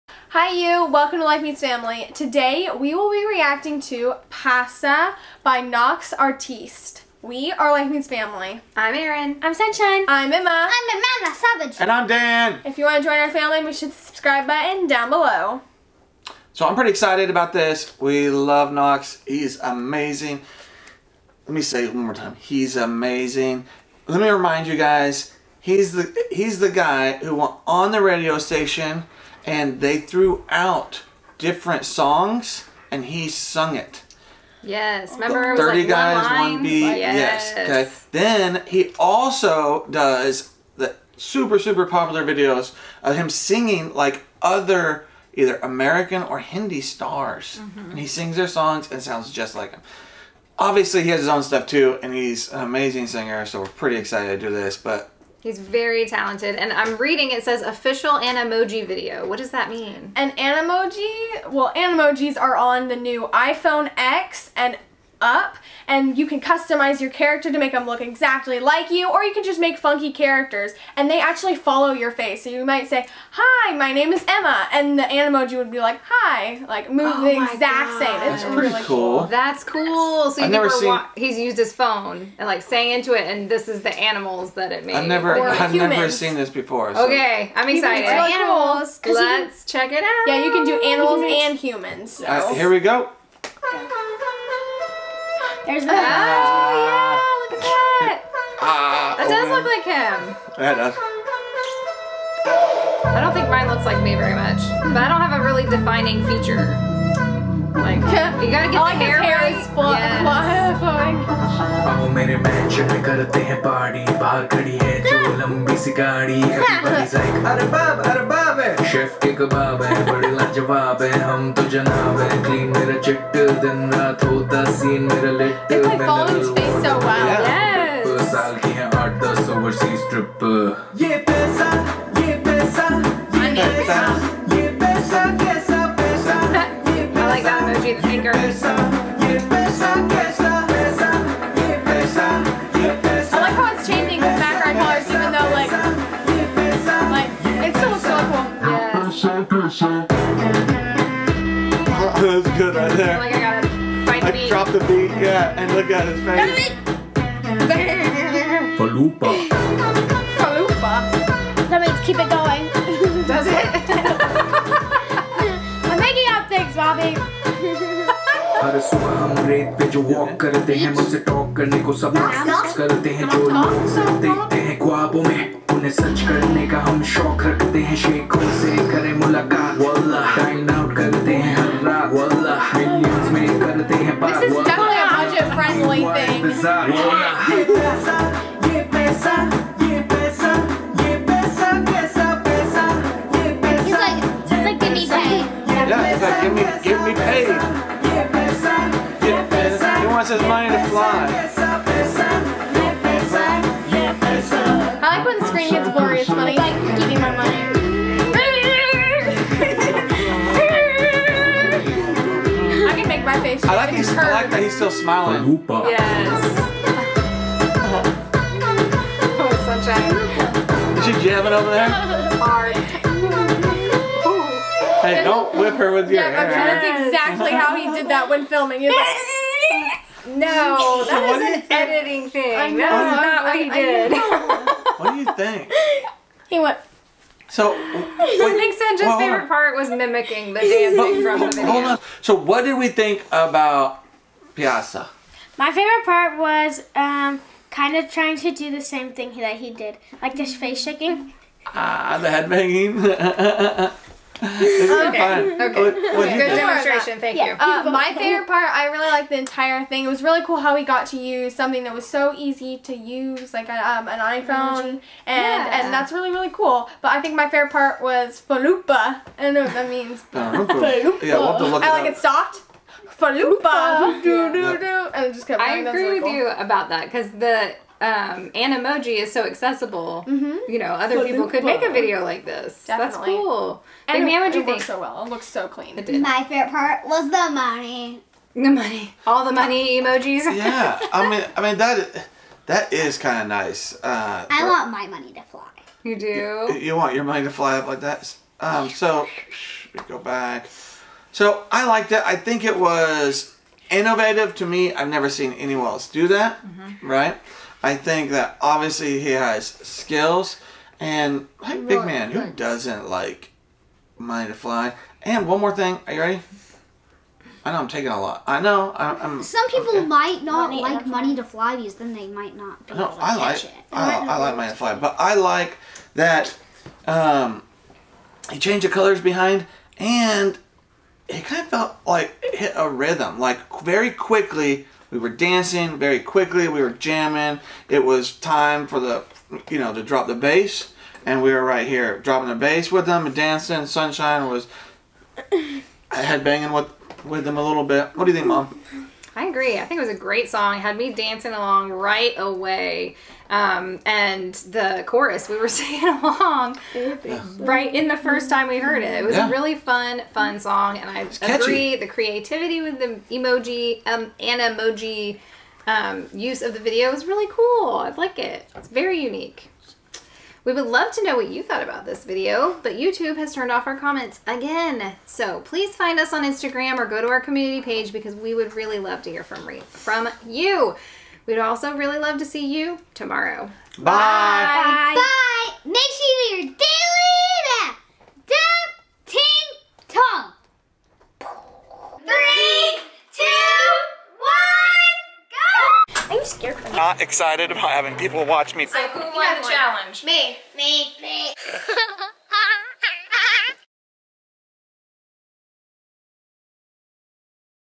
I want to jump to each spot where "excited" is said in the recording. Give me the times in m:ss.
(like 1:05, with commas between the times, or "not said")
0:16, 0:53, 1:27, 6:37.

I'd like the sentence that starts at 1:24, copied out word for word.
I've never, I've never seen this before.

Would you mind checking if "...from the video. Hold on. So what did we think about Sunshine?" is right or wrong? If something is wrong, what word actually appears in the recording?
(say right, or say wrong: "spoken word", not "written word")
wrong: "Paisa", not "Sunshine".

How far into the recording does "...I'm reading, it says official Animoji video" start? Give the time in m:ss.
0:56.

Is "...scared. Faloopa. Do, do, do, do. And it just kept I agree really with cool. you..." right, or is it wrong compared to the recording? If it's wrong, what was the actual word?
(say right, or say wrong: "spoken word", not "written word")
wrong: "stopped", not "scared".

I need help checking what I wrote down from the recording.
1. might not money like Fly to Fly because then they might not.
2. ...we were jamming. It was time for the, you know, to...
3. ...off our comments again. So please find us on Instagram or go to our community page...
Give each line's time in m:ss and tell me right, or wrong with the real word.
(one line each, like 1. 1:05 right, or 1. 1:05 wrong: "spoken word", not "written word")
1. 5:20 wrong: "Money", not "Fly"
2. 5:36 right
3. 6:13 right.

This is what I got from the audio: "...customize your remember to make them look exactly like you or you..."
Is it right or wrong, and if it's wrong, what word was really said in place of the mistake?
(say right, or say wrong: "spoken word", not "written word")
wrong: "character", not "remember".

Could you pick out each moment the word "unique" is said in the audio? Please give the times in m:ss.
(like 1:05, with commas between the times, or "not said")
6:09.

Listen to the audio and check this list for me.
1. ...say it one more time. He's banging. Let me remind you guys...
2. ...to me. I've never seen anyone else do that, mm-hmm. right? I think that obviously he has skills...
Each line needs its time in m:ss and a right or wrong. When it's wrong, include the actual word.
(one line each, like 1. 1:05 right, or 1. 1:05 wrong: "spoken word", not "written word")
1. 0:21 wrong: "amazing", not "banging"
2. 5:04 right.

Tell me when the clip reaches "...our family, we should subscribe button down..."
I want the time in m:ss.
0:13.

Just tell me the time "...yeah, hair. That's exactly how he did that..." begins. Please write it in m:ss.
3:46.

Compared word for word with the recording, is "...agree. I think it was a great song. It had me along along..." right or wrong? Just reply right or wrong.
wrong.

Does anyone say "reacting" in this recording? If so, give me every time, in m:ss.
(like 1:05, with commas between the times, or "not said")
0:03.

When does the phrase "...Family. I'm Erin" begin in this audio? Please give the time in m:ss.
0:08.